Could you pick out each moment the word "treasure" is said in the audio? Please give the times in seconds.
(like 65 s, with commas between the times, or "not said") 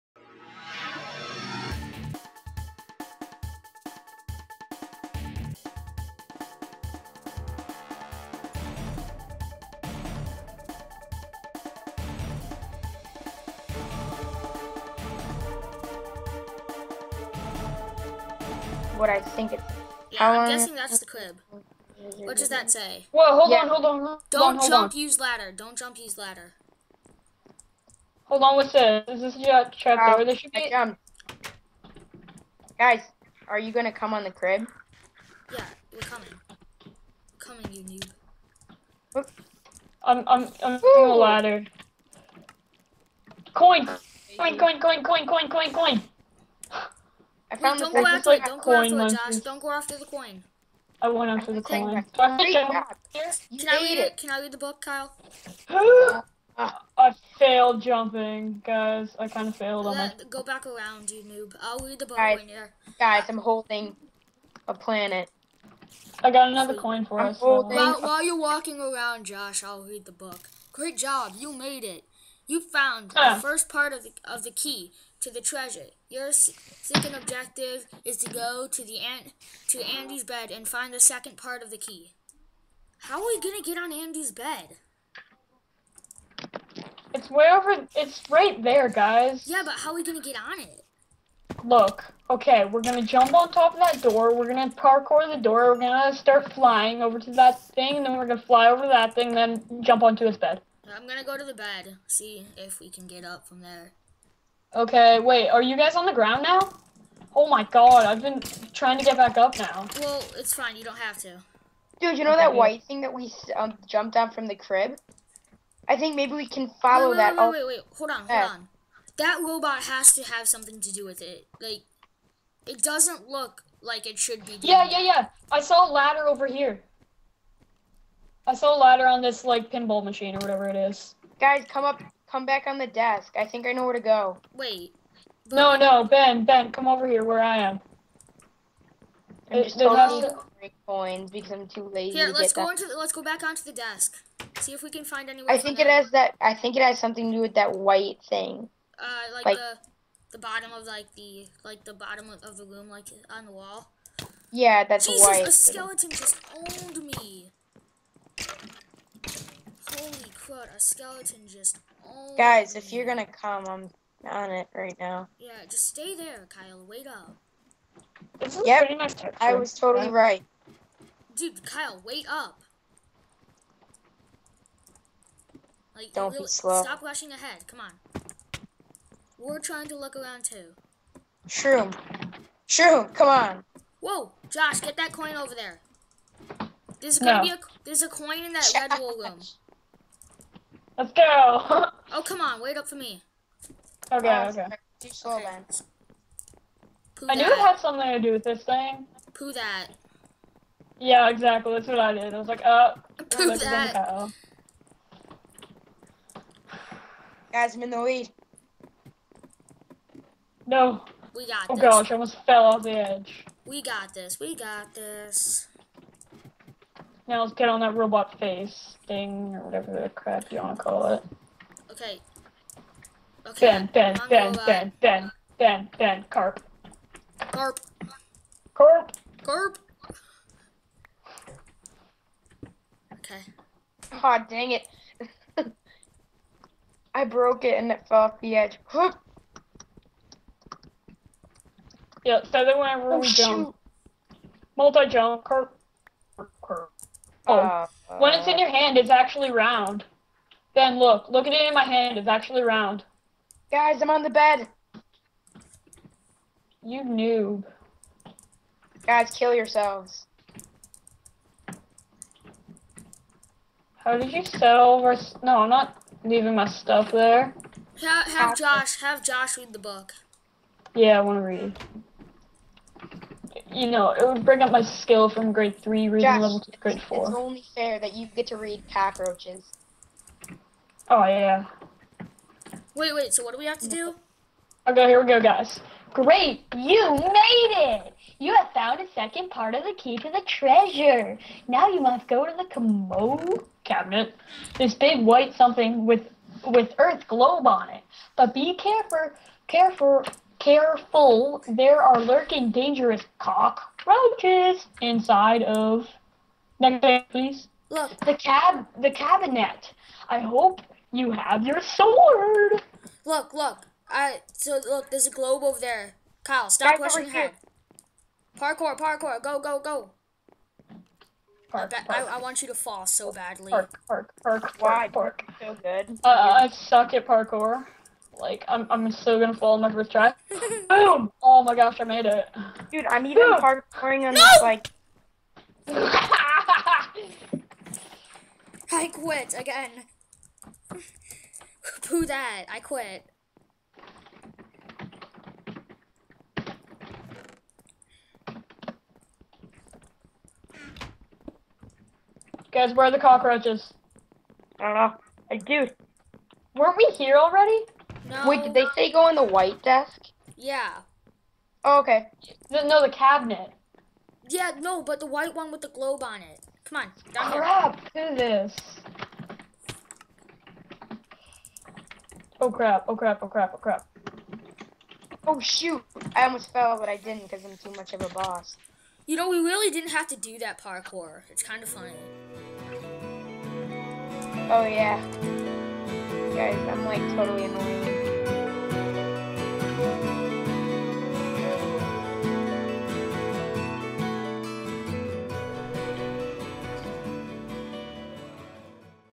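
75 s, 290 s.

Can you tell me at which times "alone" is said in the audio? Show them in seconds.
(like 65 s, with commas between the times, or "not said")
not said.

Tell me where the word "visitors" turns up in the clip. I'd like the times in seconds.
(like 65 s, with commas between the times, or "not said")
not said.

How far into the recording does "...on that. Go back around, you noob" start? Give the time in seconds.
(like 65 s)
59 s.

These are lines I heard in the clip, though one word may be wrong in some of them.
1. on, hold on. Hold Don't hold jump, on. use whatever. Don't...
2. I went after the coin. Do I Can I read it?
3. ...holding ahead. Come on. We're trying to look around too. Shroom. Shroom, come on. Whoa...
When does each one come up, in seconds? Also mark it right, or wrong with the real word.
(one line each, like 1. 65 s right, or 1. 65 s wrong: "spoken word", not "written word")
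1. 23 s wrong: "ladder", not "whatever"
2. 51 s right
3. 177 s wrong: "rushing", not "holding".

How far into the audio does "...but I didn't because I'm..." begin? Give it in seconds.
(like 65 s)
376 s.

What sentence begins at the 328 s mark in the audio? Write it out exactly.
Like, I'm, I'm so gonna fall on my first try.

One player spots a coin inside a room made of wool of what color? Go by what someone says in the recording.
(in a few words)
Red.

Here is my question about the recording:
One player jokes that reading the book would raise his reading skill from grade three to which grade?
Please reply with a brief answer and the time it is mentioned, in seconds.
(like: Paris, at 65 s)
Grade 4, at 276 s.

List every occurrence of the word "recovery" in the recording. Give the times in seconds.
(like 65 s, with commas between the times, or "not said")
not said.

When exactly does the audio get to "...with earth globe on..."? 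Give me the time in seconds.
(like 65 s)
296 s.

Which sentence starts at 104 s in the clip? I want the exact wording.
Okay, wait, are you guys on the ground now?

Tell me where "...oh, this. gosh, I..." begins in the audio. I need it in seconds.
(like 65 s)
211 s.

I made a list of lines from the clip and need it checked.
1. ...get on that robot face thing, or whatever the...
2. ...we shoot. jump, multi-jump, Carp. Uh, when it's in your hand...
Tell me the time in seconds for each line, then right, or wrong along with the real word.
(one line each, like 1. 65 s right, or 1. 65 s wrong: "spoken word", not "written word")
1. 217 s right
2. 243 s right.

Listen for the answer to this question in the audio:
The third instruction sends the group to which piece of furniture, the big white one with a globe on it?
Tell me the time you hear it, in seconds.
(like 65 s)
292 s.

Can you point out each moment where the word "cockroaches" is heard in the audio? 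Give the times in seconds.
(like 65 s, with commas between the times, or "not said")
278 s, 303 s, 353 s.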